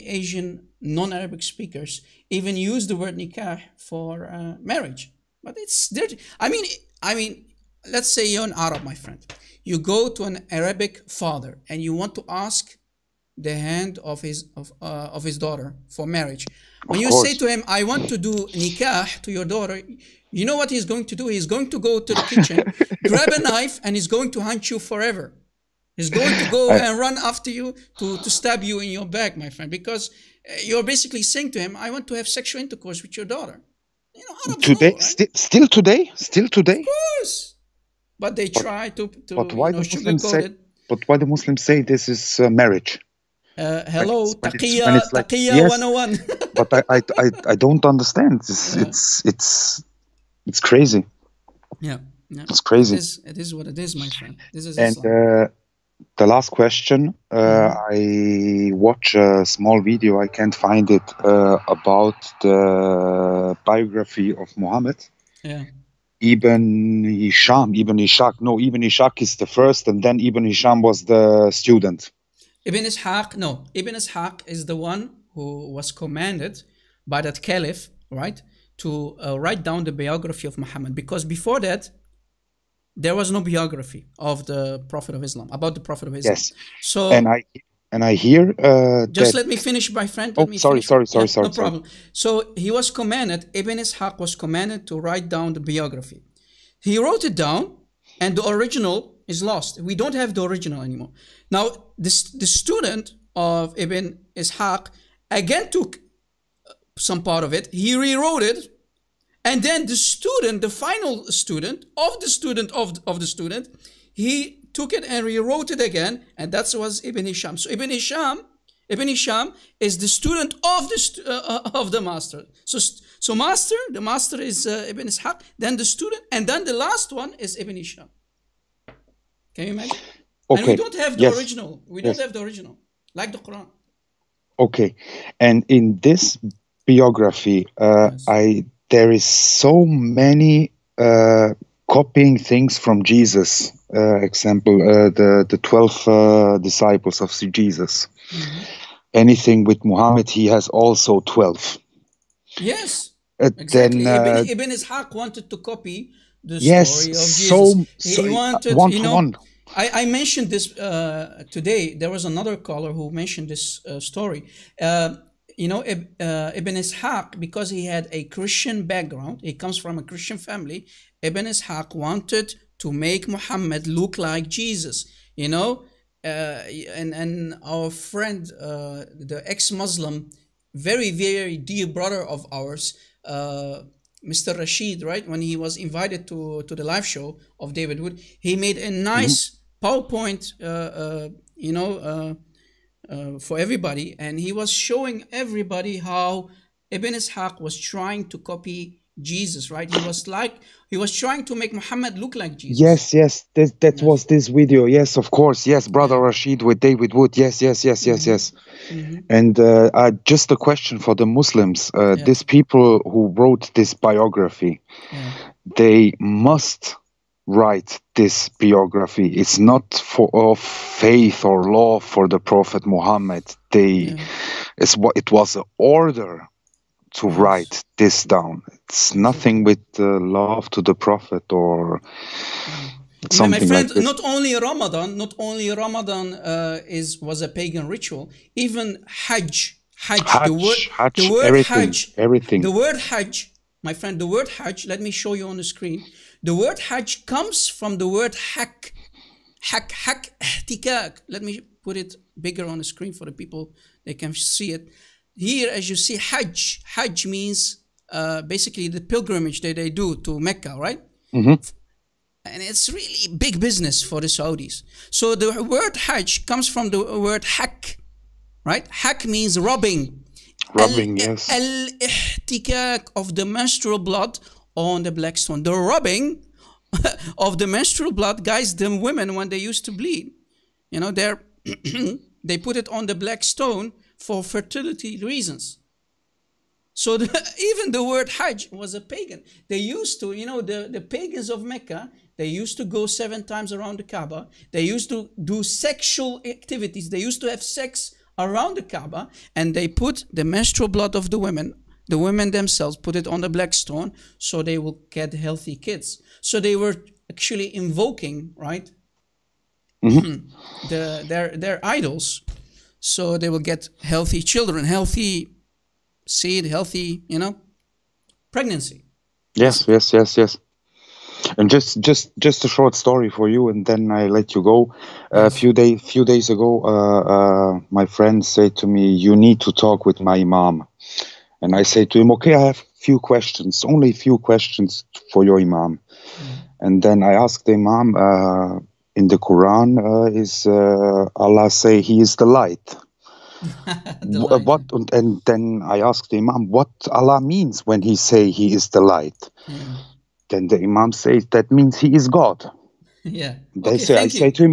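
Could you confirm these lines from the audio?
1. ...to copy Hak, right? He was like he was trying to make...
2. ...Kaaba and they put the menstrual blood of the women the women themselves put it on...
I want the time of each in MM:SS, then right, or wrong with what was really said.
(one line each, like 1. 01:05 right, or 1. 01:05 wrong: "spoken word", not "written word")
1. 03:18 wrong: "Jesus", not "Hak"
2. 04:58 right.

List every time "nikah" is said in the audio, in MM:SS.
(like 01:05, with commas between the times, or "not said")
00:03, 00:18.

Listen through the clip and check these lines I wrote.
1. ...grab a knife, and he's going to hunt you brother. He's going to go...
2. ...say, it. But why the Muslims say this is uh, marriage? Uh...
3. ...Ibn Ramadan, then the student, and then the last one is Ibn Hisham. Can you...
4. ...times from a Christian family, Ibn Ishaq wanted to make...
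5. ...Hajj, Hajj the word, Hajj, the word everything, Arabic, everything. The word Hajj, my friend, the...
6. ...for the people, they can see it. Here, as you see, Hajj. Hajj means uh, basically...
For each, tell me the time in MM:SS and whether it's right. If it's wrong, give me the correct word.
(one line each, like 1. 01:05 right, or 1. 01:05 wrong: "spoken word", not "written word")
1. 00:23 wrong: "forever", not "brother"
2. 00:40 right
3. 02:04 wrong: "Ishaq", not "Ramadan"
4. 02:49 wrong: "comes", not "times"
5. 04:00 wrong: "Hajj", not "Arabic"
6. 04:13 right.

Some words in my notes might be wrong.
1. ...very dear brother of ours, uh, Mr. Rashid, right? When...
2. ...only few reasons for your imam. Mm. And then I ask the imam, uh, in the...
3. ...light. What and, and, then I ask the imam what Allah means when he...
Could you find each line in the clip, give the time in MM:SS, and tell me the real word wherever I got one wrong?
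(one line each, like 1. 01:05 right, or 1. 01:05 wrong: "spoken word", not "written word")
1. 03:01 right
2. 05:33 wrong: "questions", not "reasons"
3. 05:44 right.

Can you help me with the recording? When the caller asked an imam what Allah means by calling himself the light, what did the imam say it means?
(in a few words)
He is God.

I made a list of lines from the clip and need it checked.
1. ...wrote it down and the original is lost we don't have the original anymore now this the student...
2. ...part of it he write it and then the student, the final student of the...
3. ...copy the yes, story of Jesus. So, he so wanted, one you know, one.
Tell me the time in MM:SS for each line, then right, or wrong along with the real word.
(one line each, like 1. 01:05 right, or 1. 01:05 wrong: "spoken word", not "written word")
1. 01:36 right
2. 01:47 wrong: "rewrote", not "write"
3. 02:35 right.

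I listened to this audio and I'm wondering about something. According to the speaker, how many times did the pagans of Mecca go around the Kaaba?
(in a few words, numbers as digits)
7.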